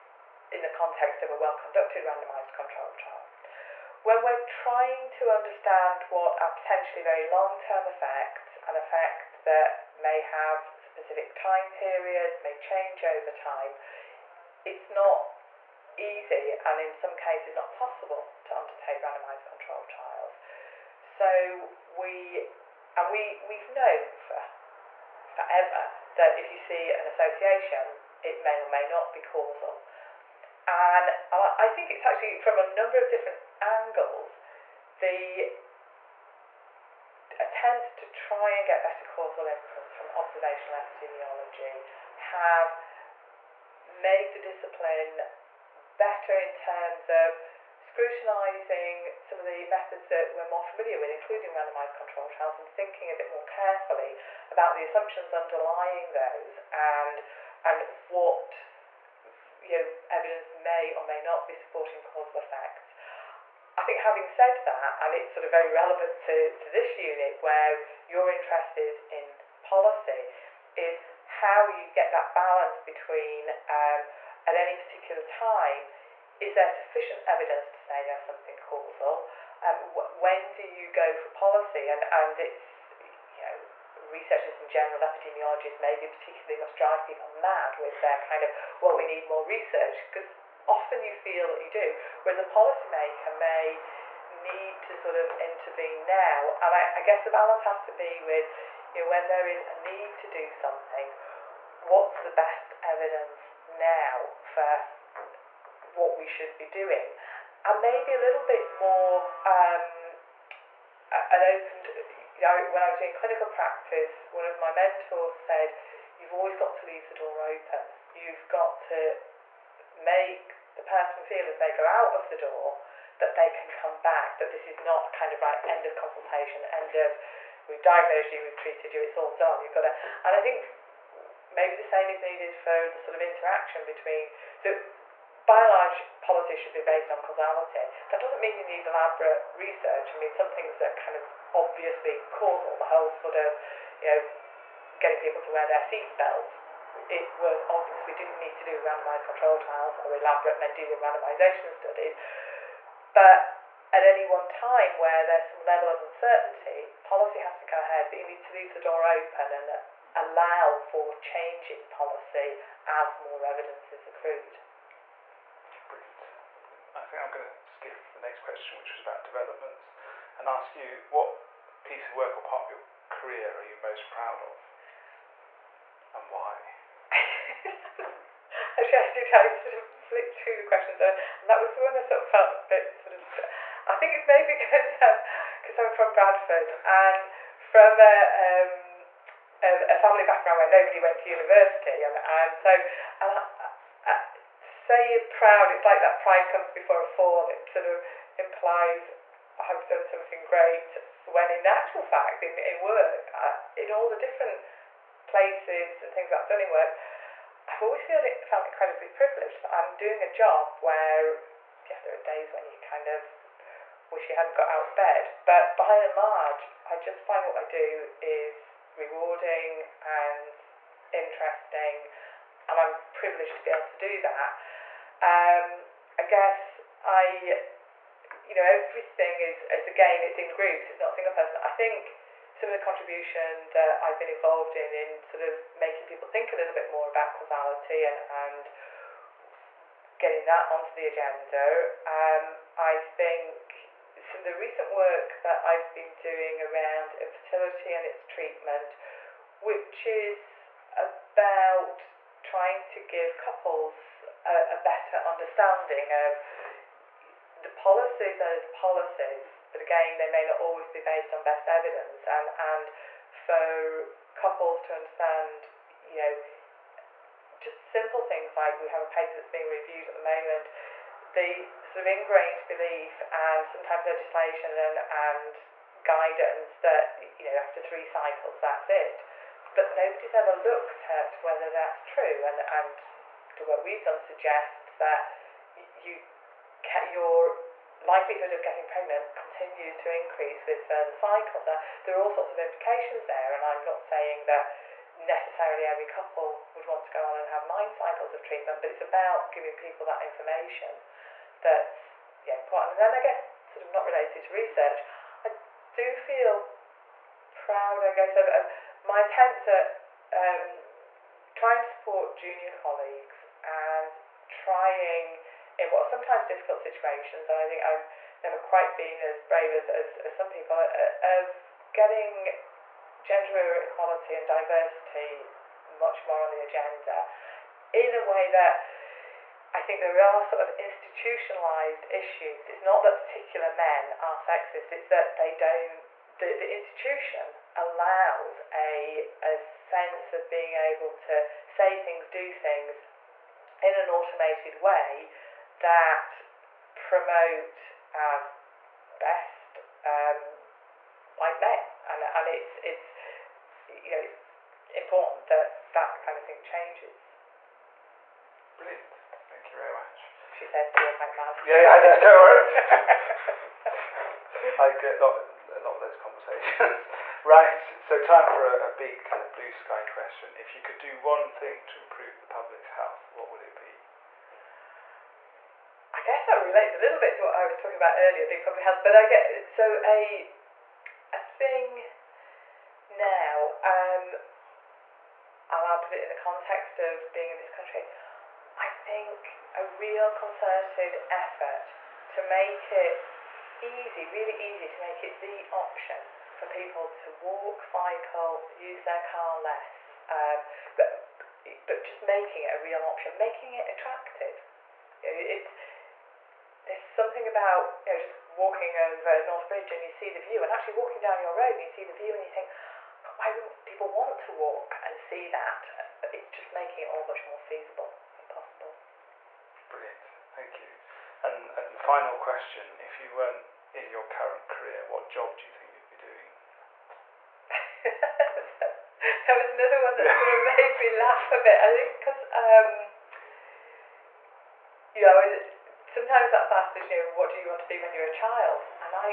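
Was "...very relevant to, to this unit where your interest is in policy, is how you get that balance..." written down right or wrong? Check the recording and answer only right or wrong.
right.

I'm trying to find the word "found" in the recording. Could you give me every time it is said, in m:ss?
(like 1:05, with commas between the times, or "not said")
not said.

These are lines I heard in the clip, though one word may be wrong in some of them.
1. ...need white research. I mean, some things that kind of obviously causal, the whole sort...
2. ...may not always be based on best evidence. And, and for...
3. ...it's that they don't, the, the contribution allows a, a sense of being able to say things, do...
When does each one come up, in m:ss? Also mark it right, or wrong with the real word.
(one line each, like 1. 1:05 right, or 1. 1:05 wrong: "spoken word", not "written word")
1. 2:18 wrong: "elaborate", not "white"
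2. 4:20 right
3. 5:34 wrong: "institution", not "contribution".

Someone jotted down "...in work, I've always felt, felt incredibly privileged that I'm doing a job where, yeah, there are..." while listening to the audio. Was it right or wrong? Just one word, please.
right.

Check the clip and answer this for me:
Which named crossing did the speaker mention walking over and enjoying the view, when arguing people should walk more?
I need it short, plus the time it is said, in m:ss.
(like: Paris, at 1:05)
North Bridge, at 6:49.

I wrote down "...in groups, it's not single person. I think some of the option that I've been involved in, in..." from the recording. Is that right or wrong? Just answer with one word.
wrong.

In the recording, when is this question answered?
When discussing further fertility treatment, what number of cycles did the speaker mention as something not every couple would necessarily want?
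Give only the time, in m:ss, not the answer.
4:57.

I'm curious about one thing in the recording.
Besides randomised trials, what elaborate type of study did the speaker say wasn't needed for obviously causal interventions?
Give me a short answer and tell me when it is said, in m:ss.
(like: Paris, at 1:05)
Mendelian randomisation, at 2:30.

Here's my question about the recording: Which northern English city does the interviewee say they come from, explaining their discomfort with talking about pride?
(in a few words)
Bradford.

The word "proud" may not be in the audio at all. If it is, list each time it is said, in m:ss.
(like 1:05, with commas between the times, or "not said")
2:54, 3:15, 5:07.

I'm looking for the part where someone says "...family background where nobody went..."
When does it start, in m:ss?
3:09.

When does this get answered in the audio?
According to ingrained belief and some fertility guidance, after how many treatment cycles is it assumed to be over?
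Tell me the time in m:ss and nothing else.
4:37.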